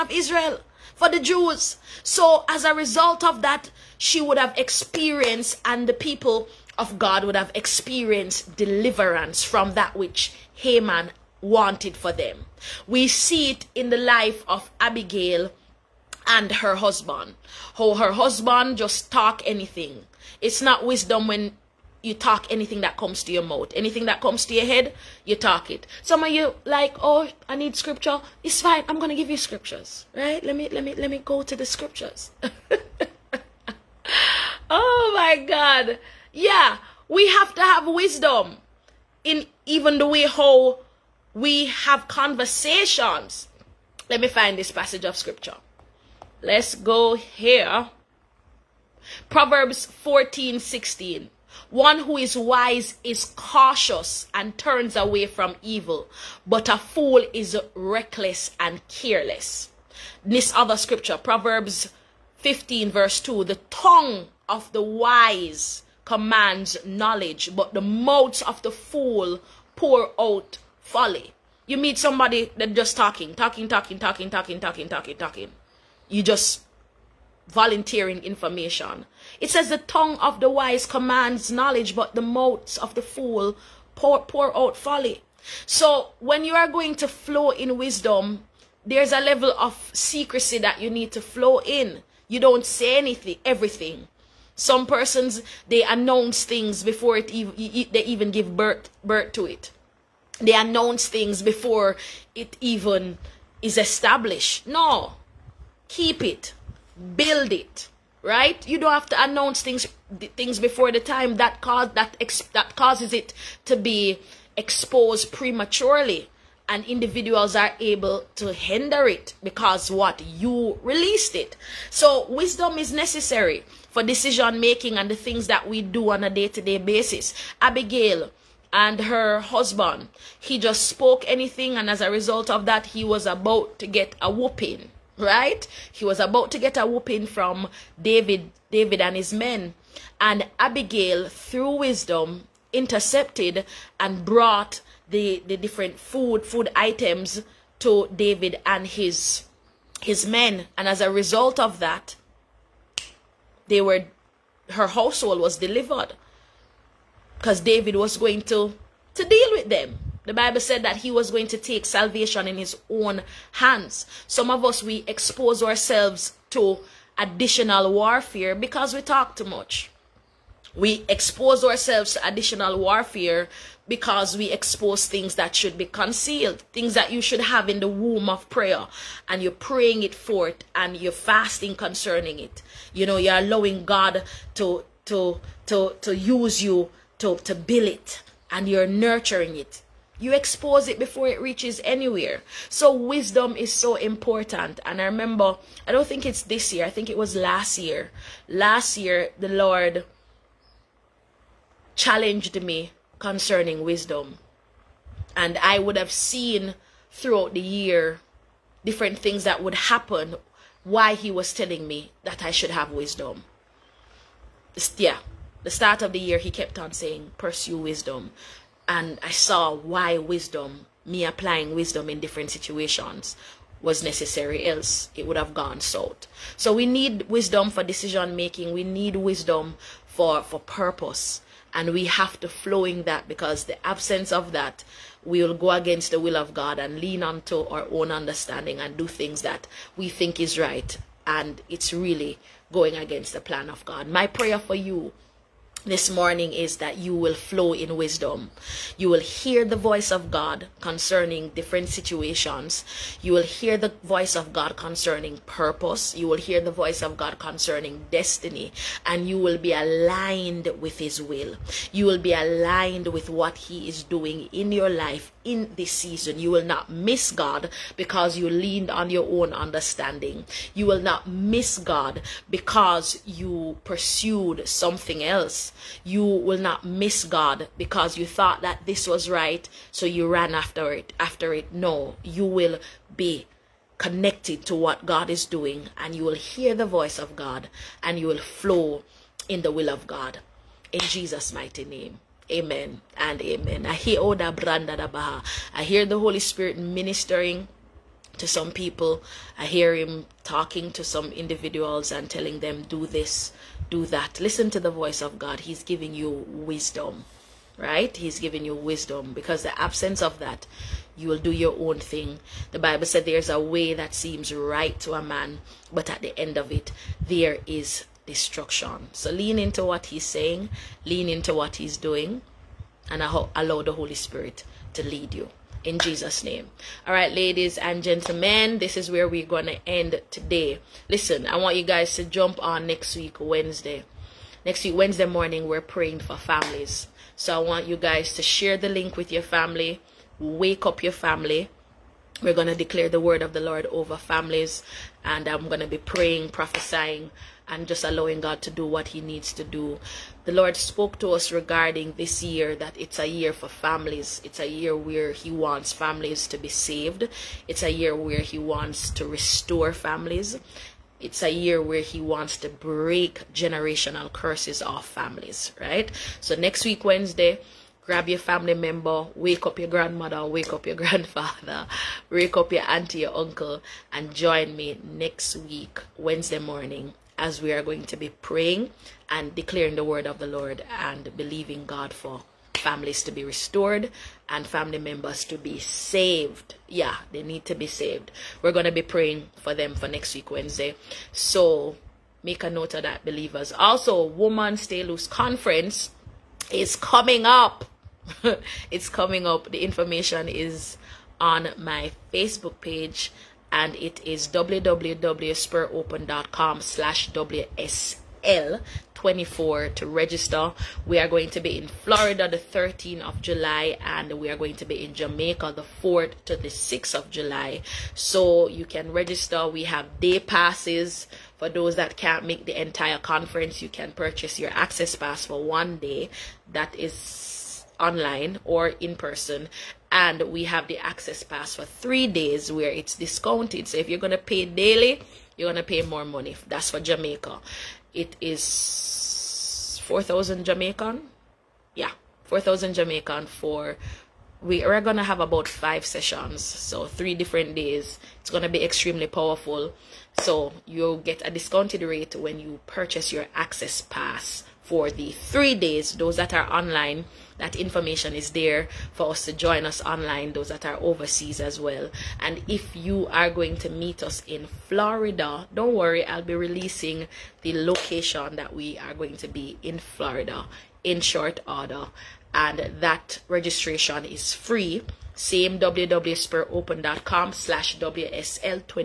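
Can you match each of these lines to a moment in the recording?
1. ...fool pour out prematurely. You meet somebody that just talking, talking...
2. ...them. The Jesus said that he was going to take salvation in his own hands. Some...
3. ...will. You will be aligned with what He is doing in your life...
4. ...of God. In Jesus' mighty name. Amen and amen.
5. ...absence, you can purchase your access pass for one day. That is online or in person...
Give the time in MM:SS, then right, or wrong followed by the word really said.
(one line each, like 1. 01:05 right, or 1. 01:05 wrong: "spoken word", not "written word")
1. 01:08 wrong: "folly", not "prematurely"
2. 02:39 wrong: "Bible", not "Jesus"
3. 04:21 right
4. 04:49 right
5. 07:03 wrong: "conference", not "absence".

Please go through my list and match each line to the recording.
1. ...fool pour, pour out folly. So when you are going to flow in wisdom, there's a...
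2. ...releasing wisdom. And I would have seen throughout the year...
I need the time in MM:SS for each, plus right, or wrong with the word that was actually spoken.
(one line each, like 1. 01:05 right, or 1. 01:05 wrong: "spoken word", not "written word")
1. 01:23 right
2. 03:23 wrong: "concerning", not "releasing".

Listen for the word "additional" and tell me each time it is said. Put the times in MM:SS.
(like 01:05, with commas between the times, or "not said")
02:47, 02:52.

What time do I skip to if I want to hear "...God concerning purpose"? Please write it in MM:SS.
04:14.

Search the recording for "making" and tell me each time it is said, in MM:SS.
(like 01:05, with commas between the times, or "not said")
02:04, 03:48.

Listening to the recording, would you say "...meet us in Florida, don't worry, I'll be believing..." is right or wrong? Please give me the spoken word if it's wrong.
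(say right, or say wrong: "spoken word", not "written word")
wrong: "releasing", not "believing".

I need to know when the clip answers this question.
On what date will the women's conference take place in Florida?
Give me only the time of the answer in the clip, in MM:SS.
06:52.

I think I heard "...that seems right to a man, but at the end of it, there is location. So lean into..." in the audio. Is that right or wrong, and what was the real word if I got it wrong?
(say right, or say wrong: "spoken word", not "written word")
wrong: "destruction", not "location".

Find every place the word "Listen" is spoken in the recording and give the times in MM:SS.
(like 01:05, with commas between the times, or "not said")
05:04, 05:31.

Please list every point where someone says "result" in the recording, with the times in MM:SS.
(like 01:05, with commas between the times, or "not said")
00:02, 02:12, 02:31.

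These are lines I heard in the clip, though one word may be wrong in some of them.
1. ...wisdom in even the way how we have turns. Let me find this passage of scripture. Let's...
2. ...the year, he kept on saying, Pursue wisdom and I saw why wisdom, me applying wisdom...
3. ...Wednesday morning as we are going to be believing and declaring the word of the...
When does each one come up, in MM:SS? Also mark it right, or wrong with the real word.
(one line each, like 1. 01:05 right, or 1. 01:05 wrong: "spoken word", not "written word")
1. 00:37 wrong: "conversations", not "turns"
2. 03:36 right
3. 06:16 wrong: "praying", not "believing".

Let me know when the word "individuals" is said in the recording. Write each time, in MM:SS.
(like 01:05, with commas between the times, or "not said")
01:56, 05:01.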